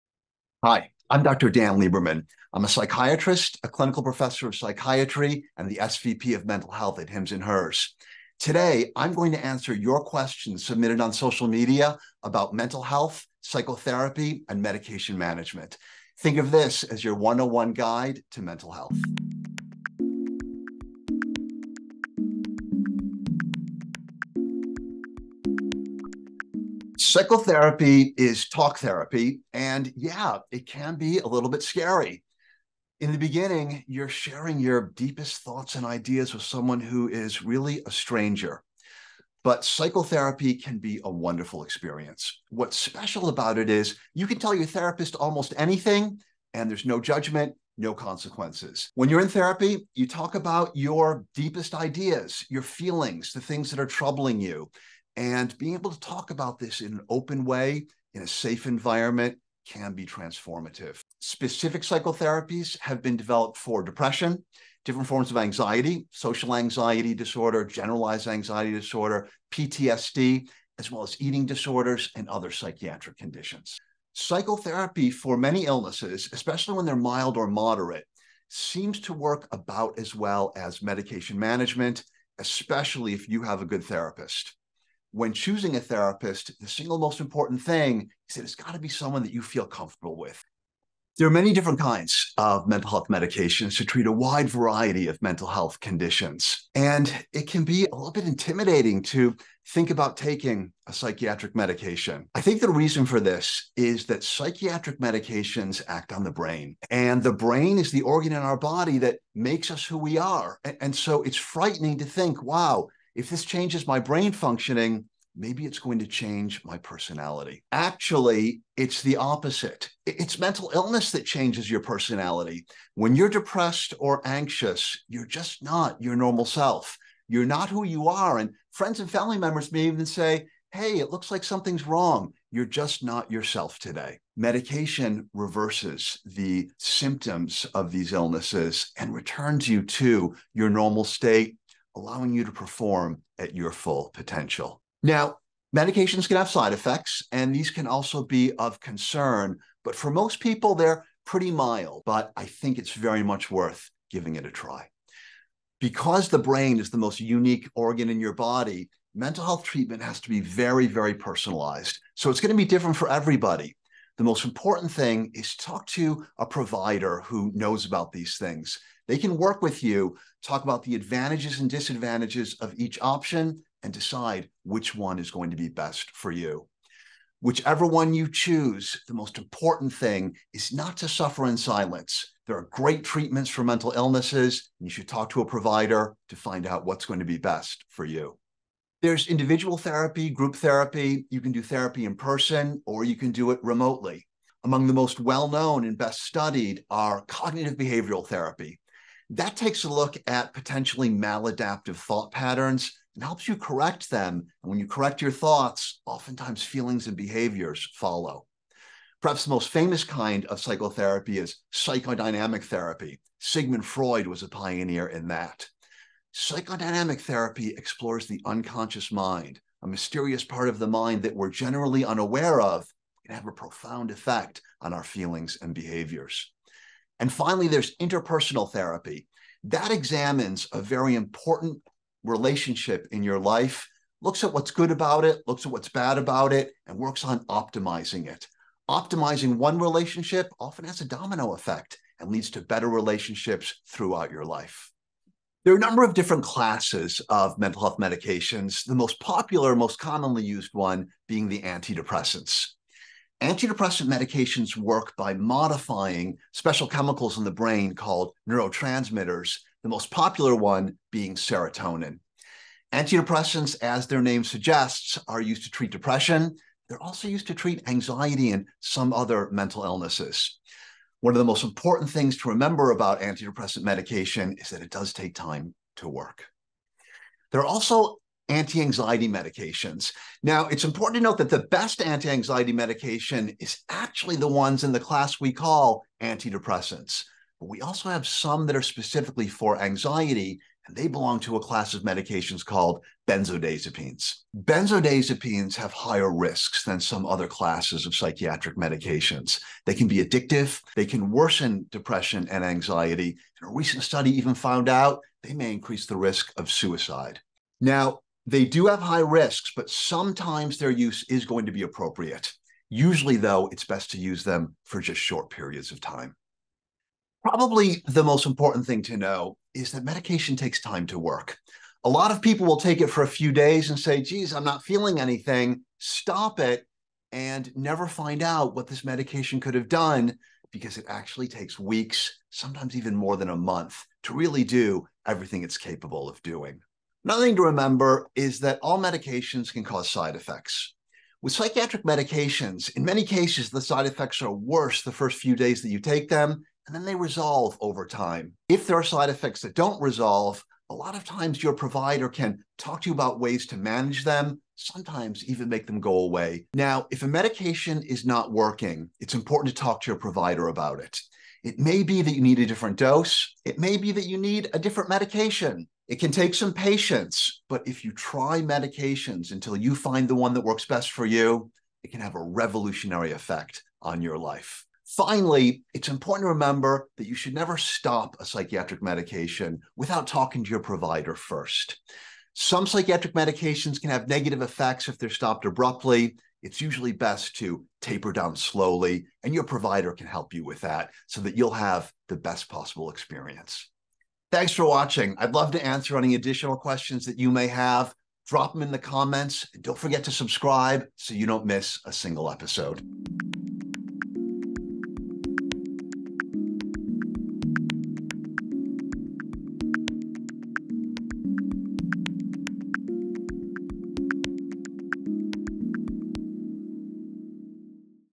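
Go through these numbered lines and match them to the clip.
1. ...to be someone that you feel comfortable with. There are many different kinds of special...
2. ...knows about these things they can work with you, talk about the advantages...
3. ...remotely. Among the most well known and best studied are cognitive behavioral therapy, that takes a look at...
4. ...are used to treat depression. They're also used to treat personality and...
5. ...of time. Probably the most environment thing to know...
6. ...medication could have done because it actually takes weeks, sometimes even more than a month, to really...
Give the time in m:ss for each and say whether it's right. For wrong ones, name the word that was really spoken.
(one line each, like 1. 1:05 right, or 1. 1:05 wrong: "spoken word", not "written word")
1. 1:28 wrong: "mental", not "special"
2. 2:47 right
3. 3:13 right
4. 4:25 wrong: "anxiety", not "personality"
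5. 5:15 wrong: "important", not "environment"
6. 5:29 right.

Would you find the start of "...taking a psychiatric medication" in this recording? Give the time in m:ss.
1:40.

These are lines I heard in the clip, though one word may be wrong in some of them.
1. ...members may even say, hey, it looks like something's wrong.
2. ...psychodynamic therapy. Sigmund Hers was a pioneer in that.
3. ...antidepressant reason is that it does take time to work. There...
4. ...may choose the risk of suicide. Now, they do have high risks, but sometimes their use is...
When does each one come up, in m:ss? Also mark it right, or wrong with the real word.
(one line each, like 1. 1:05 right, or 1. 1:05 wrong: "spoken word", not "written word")
1. 2:09 right
2. 3:31 wrong: "Freud", not "Hers"
3. 4:33 wrong: "medication", not "reason"
4. 5:05 wrong: "increase", not "choose".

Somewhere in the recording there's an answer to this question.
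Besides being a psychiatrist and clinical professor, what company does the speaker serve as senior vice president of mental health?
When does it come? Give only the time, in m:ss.
0:07.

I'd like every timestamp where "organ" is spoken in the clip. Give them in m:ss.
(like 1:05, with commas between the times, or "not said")
1:48, 2:37.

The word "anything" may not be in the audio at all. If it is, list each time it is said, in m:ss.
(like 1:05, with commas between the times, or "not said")
0:45, 5:25.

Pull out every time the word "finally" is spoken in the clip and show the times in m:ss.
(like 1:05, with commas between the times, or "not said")
3:47, 6:15.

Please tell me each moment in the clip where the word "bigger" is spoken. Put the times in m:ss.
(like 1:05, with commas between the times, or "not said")
not said.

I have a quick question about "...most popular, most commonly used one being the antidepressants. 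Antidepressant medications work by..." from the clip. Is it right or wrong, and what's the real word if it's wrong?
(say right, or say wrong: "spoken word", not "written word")
right.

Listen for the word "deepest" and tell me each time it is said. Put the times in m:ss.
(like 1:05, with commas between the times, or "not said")
0:34, 0:51.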